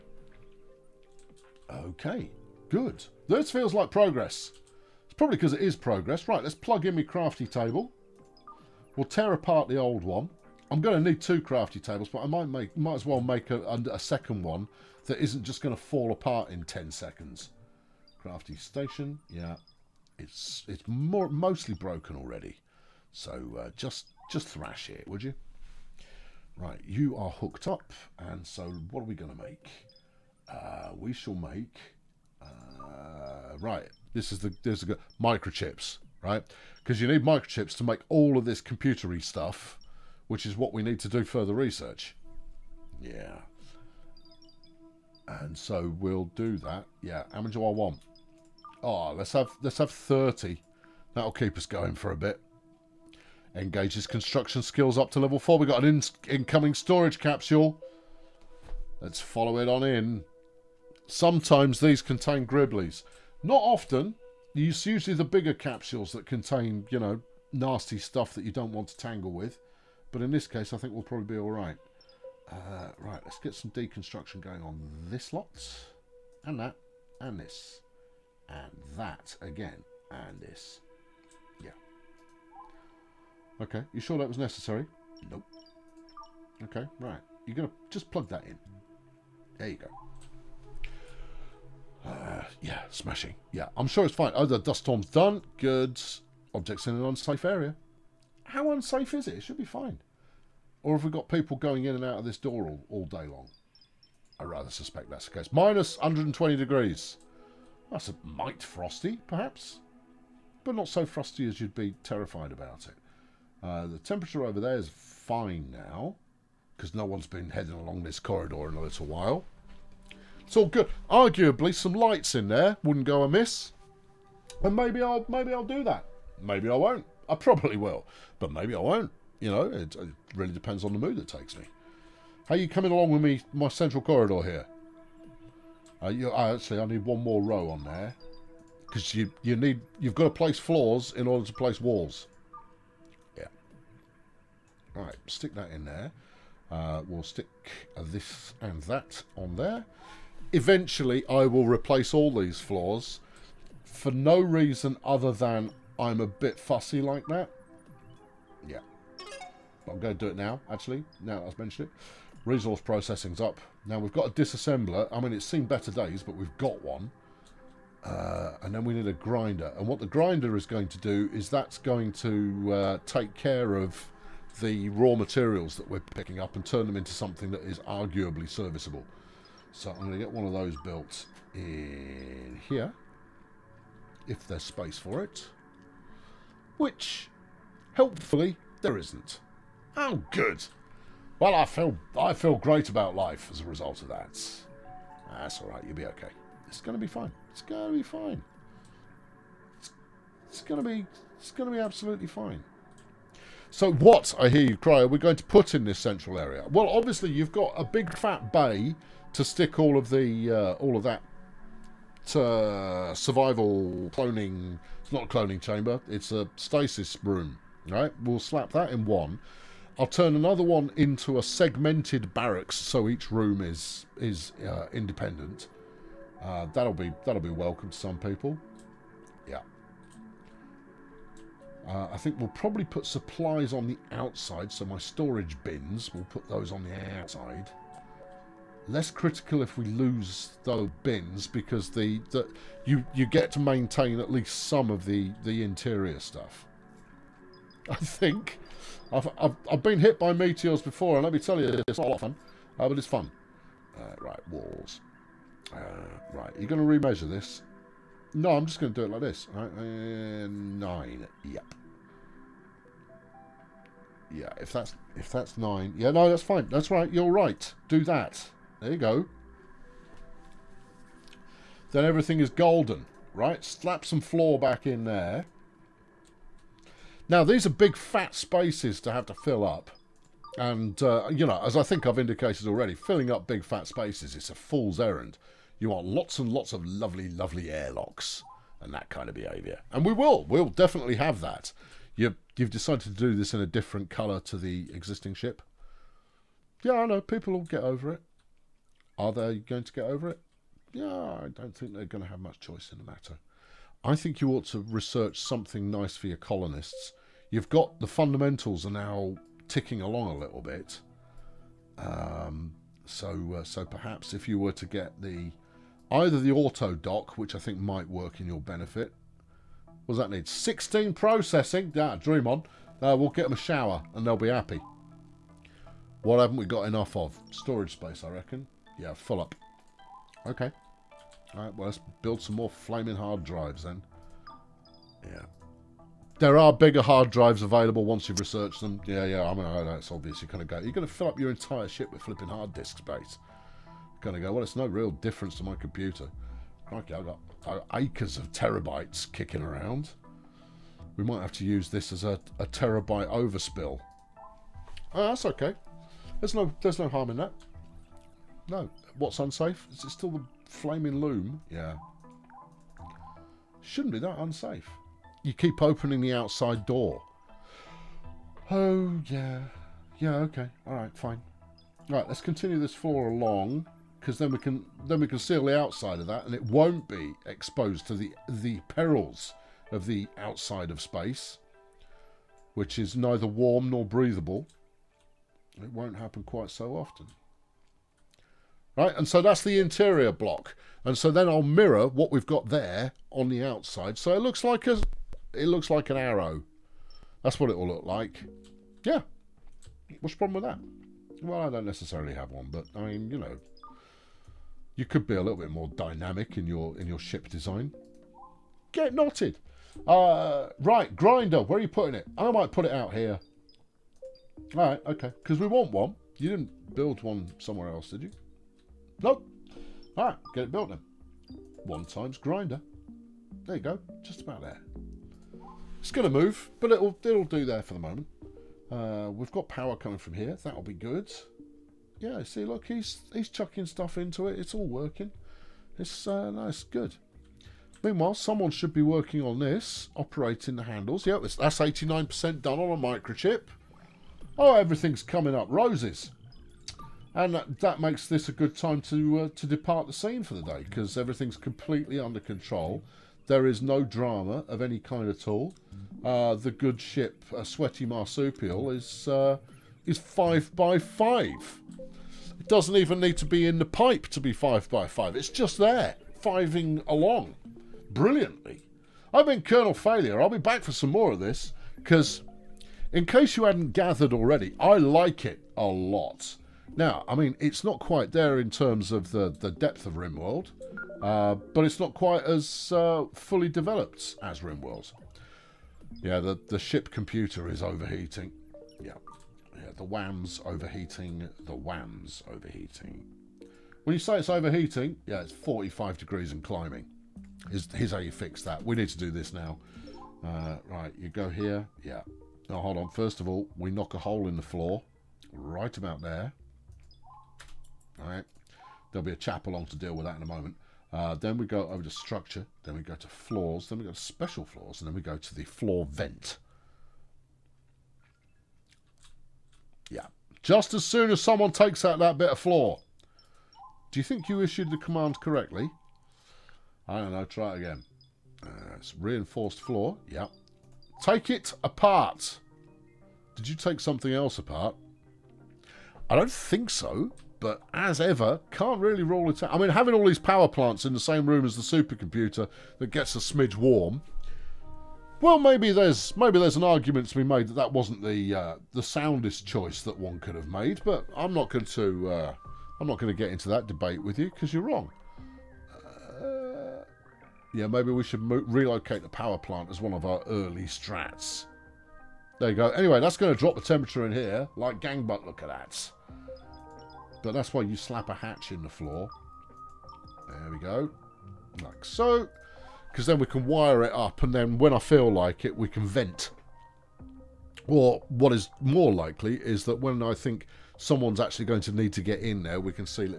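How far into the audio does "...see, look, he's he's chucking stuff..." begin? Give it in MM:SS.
07:12.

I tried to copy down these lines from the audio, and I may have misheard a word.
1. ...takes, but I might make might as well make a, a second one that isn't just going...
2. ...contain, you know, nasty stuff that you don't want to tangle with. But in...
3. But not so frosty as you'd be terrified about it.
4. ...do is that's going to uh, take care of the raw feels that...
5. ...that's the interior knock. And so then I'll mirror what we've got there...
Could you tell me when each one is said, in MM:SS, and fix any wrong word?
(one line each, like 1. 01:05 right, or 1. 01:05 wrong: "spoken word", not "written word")
1. 00:11 wrong: "tables", not "takes"
2. 01:06 right
3. 01:50 right
4. 02:50 wrong: "materials", not "feels"
5. 06:29 wrong: "block", not "knock".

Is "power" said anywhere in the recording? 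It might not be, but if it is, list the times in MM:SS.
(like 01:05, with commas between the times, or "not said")
07:09, 09:00, 09:19.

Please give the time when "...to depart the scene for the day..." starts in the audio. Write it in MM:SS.
07:29.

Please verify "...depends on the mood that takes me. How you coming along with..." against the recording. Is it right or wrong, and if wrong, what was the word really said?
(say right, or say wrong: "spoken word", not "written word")
right.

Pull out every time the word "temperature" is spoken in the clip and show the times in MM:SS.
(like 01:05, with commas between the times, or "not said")
01:53, 09:23.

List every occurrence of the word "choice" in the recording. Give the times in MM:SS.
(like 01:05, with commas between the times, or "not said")
05:02, 09:09.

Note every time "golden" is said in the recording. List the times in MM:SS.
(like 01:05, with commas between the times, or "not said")
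04:32.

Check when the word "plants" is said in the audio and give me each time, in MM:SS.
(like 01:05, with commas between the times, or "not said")
09:00, 09:19.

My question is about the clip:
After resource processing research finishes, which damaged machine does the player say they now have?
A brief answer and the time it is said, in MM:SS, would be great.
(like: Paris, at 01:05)
A disassembler, at 02:44.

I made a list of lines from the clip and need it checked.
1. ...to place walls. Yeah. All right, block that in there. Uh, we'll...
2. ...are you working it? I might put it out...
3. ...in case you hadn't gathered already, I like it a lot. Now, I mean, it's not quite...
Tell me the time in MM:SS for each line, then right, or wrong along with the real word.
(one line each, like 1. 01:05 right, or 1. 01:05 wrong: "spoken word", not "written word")
1. 02:21 wrong: "stick", not "block"
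2. 06:51 wrong: "putting", not "working"
3. 07:53 right.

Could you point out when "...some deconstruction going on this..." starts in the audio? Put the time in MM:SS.
01:13.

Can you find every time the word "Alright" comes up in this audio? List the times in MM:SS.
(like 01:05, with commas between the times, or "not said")
05:31.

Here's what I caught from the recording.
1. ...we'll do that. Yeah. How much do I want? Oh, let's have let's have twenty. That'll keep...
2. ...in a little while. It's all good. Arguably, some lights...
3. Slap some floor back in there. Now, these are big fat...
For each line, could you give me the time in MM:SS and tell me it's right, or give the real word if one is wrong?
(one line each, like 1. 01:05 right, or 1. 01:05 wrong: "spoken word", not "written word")
1. 00:45 wrong: "thirty", not "twenty"
2. 01:58 right
3. 04:33 right.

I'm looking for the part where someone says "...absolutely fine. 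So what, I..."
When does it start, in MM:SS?
03:21.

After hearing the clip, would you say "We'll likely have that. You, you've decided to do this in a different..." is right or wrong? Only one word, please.
wrong.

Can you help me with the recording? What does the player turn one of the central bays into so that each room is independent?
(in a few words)
Segmented barracks.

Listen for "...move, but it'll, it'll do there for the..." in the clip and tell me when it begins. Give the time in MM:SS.
07:06.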